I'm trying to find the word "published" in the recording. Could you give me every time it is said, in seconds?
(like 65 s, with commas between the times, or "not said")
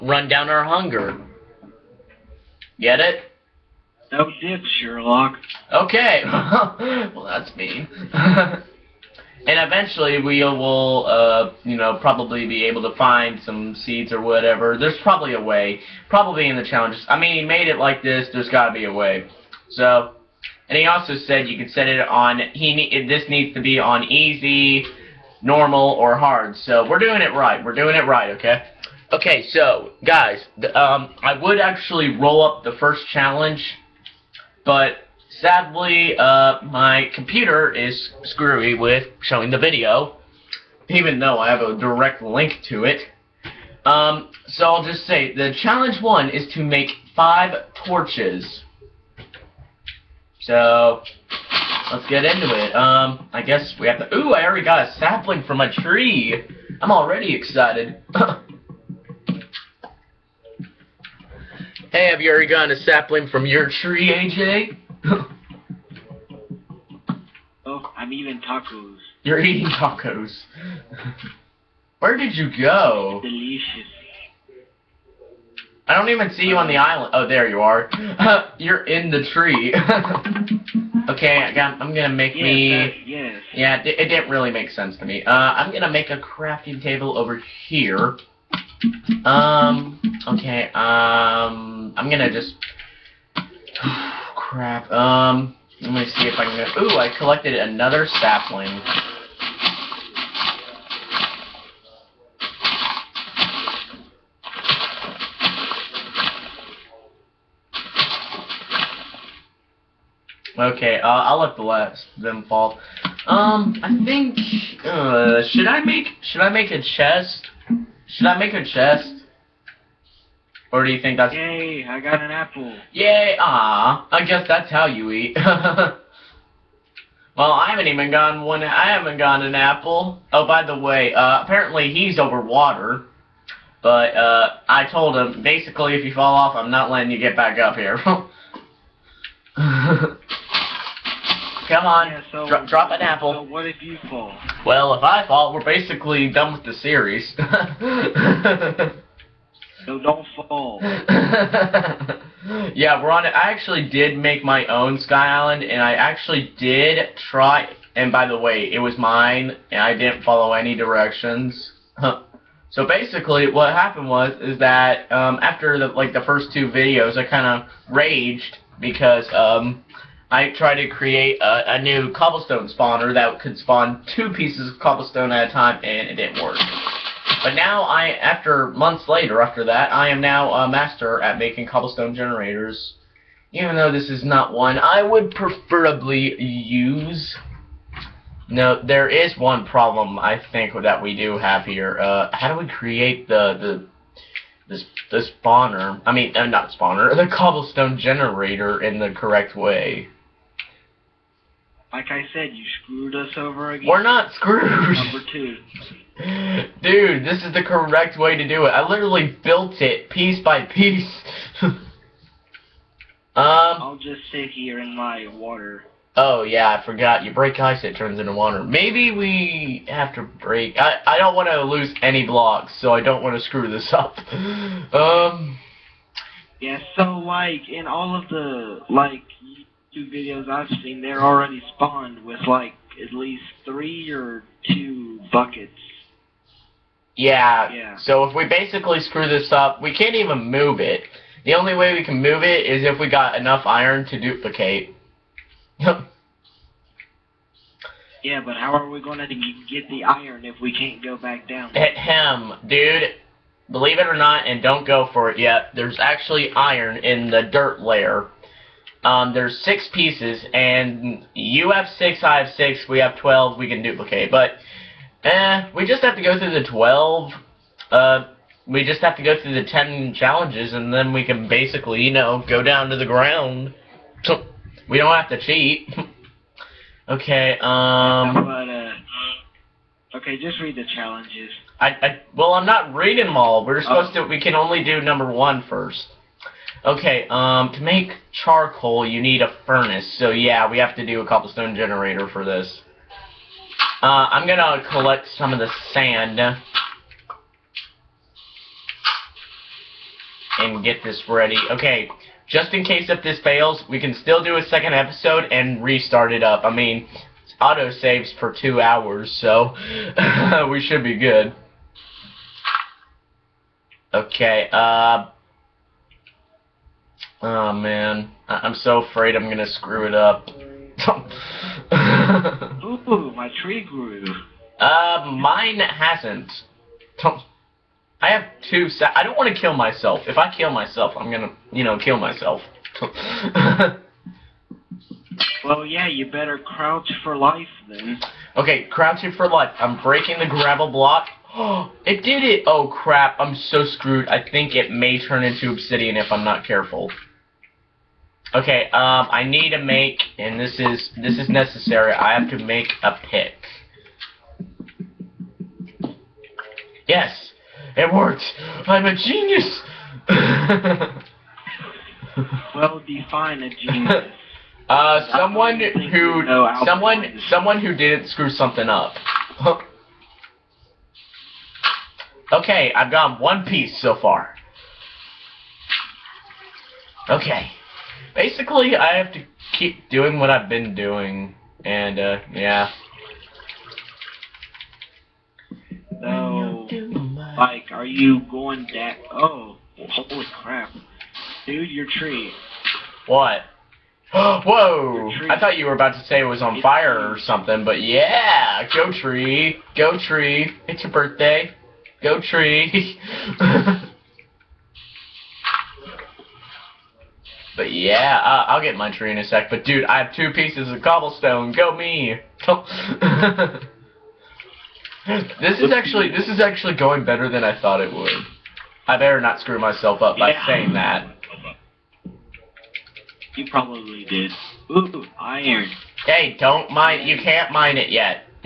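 not said.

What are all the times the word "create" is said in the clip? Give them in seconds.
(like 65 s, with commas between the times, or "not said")
170 s, 192 s.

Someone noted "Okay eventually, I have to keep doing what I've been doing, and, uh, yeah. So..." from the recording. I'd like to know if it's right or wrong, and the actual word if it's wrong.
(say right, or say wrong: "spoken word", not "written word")
wrong: "basically", not "eventually".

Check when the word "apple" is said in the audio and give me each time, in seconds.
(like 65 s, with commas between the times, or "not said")
122 s, 129 s, 143 s.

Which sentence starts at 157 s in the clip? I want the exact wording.
And by the way, it was mine, and I didn't follow any directions.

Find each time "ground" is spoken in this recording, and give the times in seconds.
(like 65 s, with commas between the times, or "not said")
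273 s.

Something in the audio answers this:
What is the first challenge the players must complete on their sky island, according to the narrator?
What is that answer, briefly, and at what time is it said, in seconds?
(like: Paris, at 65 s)
Make 5 torches, at 46 s.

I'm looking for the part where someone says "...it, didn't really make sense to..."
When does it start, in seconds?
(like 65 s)
83 s.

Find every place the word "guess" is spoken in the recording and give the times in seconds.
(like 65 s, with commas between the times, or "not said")
53 s, 124 s.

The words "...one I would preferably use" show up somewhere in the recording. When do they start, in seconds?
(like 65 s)
184 s.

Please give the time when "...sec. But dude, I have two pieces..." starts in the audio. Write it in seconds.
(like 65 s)
409 s.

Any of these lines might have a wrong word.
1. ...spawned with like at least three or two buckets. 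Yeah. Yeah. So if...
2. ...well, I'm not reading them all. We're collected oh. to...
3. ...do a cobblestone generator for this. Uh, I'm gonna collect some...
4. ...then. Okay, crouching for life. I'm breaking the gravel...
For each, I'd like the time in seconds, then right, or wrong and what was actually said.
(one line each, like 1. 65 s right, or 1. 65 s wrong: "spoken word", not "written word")
1. 231 s right
2. 282 s wrong: "supposed", not "collected"
3. 291 s right
4. 337 s right.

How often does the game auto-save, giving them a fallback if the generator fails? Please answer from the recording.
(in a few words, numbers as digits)
2 hours.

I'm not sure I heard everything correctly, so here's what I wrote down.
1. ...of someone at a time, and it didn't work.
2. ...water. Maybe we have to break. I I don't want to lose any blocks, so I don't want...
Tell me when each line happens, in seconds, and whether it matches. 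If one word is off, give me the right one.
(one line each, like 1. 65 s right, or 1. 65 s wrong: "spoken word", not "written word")
1. 174 s wrong: "cobblestone", not "someone"
2. 218 s right.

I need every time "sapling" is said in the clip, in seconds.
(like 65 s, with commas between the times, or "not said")
54 s, 62 s, 98 s.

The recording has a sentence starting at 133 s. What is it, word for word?
But uh, I told him basically, if you fall off, I'm not letting you get back up here.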